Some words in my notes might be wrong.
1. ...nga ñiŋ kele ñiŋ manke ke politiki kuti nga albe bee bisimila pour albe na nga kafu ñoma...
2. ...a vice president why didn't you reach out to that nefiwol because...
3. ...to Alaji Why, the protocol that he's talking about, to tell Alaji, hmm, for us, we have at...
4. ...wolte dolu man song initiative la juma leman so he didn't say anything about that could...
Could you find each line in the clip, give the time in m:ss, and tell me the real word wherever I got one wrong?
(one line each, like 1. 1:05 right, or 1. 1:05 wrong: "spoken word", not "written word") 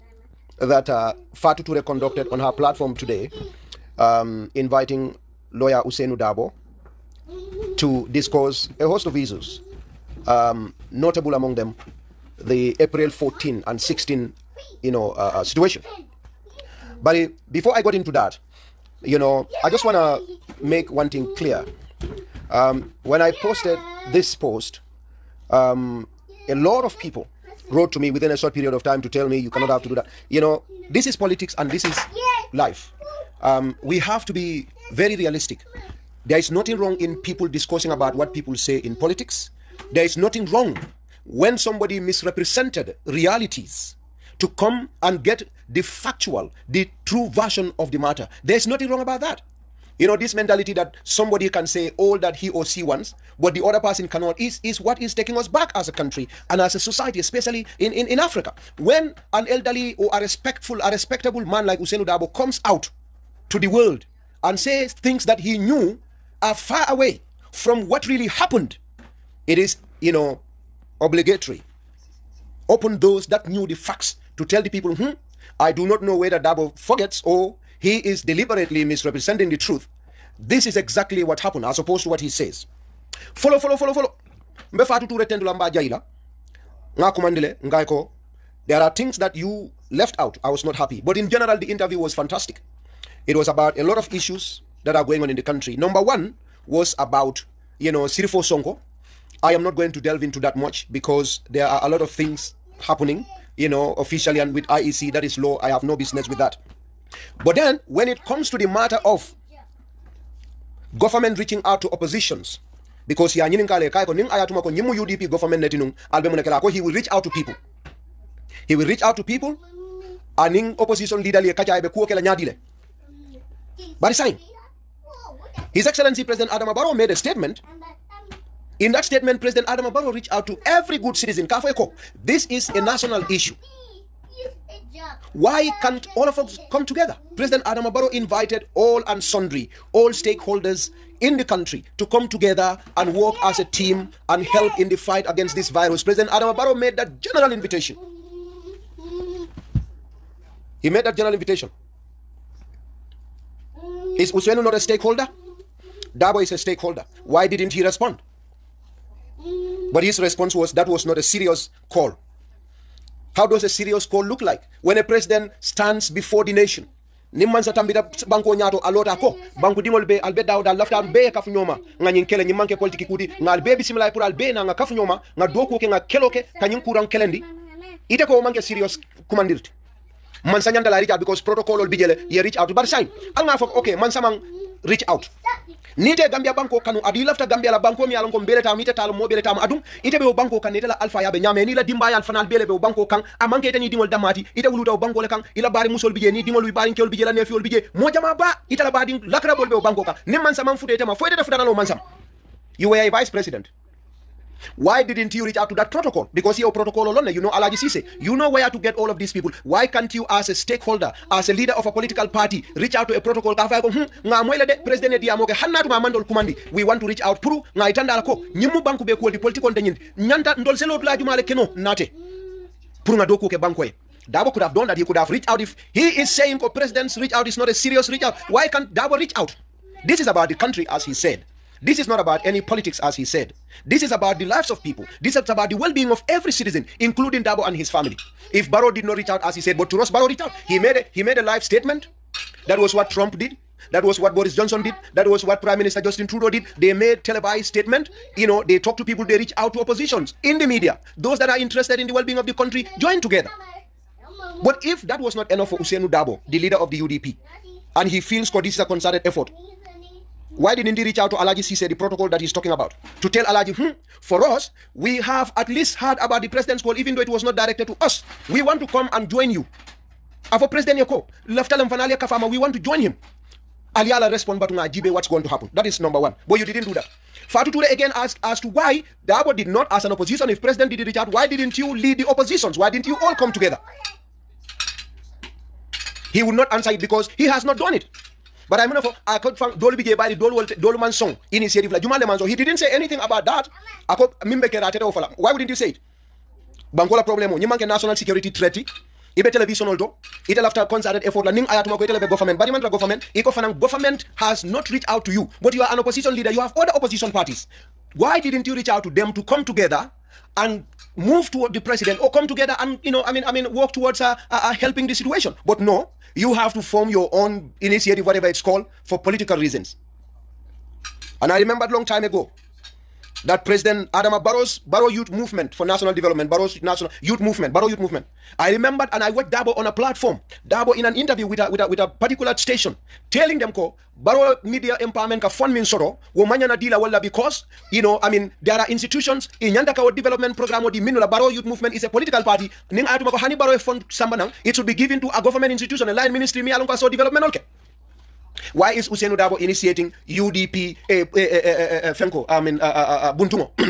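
1. 2:52 right
2. 3:22 wrong: "protocol", not "nefiwol"
3. 4:21 wrong: "Sise", not "Why"
4. 4:50 right.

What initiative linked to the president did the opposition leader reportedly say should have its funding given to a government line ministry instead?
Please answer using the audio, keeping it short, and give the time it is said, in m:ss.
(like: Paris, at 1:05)
Barrow Media Empowerment, at 5:34.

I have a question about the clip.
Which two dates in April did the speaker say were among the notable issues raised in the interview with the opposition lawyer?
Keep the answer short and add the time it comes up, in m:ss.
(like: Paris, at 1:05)
April 14 and 16, at 0:12.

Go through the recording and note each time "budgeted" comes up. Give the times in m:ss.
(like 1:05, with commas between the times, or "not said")
not said.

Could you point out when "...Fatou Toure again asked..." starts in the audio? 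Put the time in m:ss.
4:37.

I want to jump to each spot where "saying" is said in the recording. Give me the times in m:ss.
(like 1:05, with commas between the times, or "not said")
3:46.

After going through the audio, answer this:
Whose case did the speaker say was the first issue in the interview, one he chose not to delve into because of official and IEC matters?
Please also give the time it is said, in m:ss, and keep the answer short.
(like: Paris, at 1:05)
Sirifo Sonko, at 1:38.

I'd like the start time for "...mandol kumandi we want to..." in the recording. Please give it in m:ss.
3:35.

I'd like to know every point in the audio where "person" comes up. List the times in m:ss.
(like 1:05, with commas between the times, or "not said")
0:53.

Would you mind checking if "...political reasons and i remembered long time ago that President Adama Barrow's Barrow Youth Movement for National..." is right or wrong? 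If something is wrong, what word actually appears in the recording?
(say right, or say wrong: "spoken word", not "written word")
right.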